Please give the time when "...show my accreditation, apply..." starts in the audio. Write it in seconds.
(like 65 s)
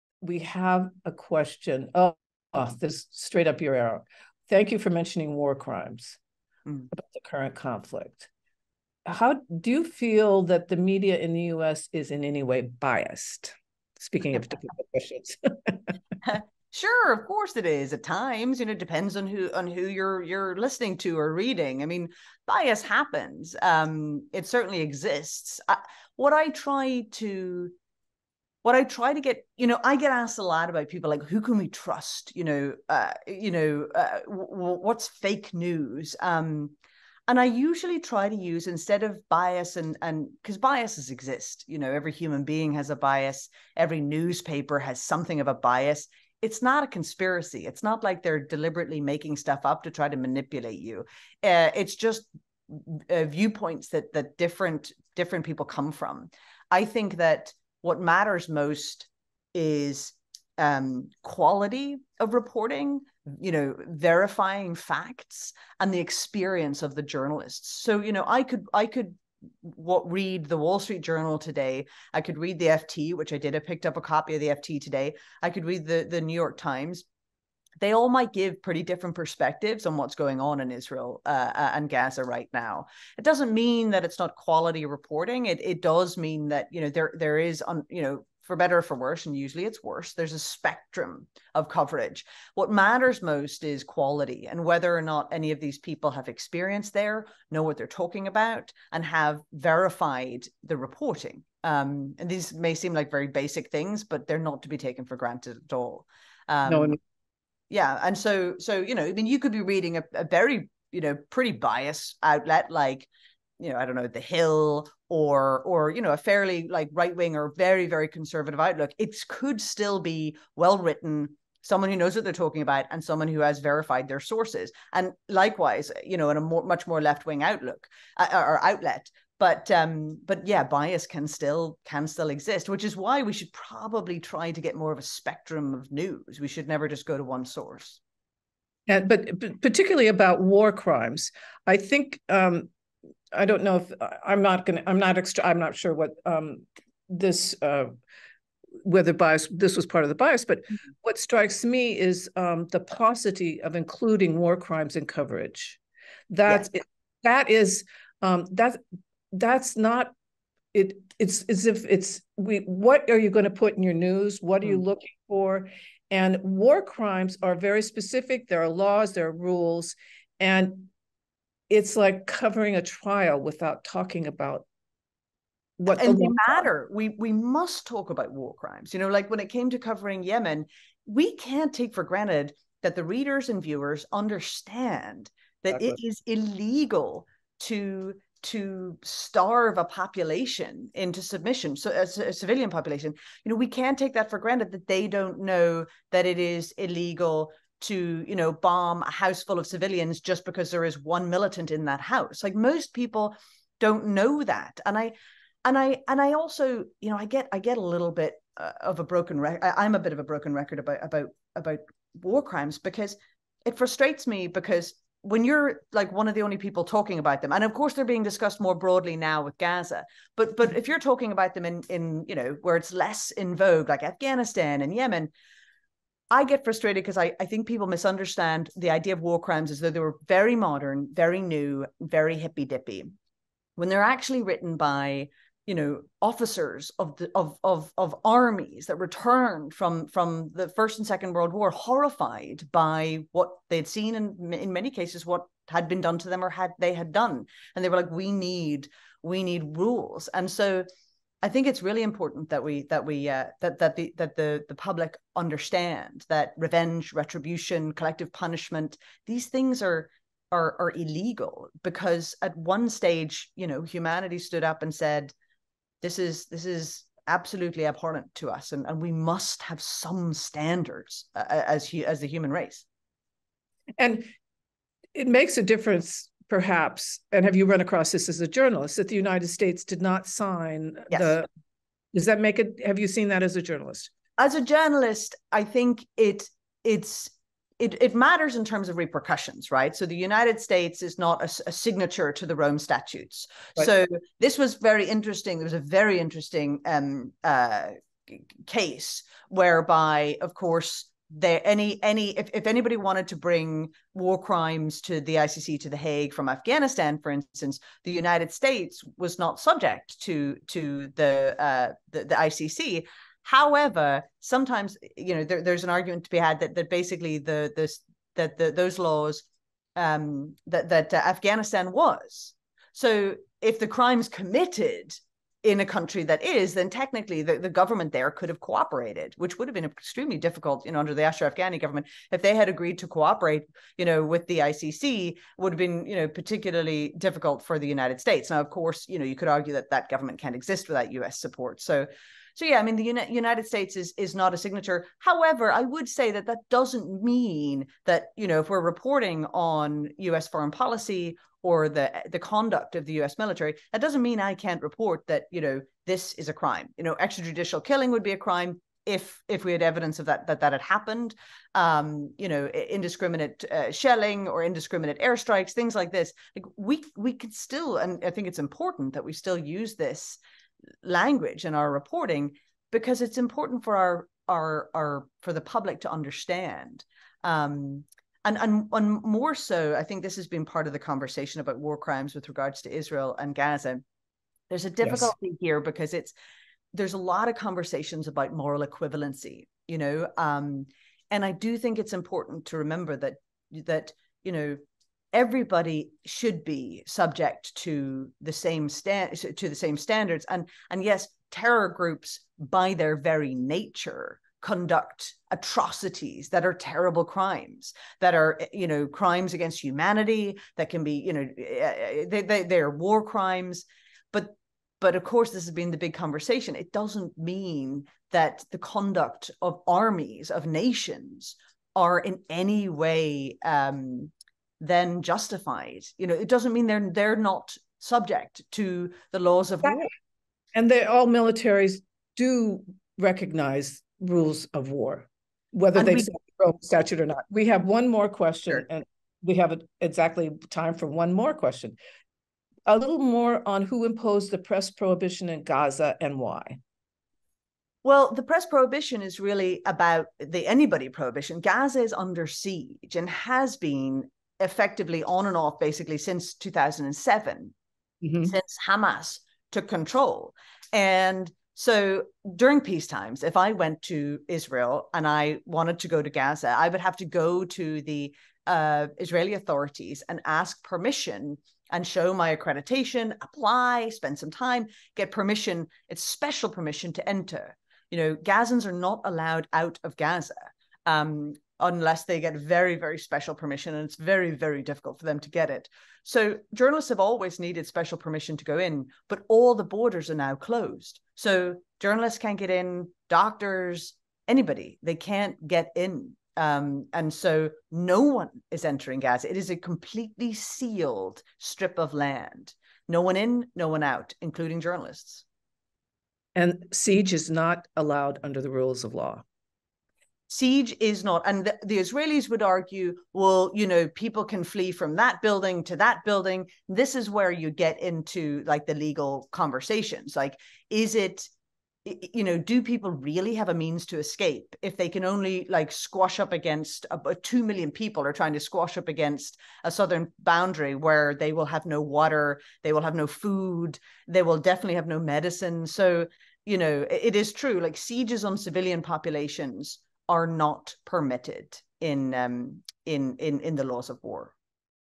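472 s.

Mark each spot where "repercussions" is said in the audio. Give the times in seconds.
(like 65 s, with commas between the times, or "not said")
288 s.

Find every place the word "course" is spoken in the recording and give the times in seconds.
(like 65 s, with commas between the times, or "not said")
17 s, 217 s, 300 s, 338 s, 415 s.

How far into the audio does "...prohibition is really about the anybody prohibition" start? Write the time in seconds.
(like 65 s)
448 s.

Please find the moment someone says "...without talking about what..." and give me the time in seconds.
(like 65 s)
173 s.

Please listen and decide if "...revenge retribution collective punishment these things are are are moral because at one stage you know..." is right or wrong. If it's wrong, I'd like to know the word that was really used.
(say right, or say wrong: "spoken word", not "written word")
wrong: "illegal", not "moral".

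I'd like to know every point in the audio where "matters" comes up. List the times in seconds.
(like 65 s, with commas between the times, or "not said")
57 s, 92 s, 176 s, 288 s.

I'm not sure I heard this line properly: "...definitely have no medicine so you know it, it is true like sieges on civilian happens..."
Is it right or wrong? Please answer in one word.
wrong.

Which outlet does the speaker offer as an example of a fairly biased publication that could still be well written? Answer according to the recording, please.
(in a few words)
The Hill.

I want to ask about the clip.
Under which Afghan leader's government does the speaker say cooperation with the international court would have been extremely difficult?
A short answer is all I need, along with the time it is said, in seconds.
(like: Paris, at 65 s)
Ashraf Ghani, at 331 s.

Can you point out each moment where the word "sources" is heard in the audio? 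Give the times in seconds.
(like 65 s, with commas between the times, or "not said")
124 s, 137 s.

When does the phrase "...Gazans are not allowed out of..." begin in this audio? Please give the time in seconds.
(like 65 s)
478 s.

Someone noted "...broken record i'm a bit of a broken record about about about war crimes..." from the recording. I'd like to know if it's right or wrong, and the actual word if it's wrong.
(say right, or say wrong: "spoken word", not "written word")
right.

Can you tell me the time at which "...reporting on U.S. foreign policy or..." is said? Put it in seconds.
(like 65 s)
348 s.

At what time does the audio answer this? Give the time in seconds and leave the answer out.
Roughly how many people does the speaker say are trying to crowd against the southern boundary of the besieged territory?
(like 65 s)
527 s.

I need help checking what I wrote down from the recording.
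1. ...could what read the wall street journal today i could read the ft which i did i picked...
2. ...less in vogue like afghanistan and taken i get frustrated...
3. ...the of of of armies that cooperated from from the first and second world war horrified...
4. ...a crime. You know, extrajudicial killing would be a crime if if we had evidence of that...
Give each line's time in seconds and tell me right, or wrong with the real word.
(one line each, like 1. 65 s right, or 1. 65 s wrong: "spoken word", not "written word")
1. 68 s right
2. 222 s wrong: "yemen", not "taken"
3. 237 s wrong: "returned", not "cooperated"
4. 356 s right.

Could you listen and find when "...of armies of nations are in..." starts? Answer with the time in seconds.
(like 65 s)
419 s.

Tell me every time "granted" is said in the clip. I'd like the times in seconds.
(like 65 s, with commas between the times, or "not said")
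105 s, 182 s, 194 s.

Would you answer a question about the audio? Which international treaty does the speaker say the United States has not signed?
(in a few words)
Rome Statutes.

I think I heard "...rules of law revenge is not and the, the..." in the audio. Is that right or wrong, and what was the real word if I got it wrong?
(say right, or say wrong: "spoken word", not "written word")
wrong: "siege", not "revenge".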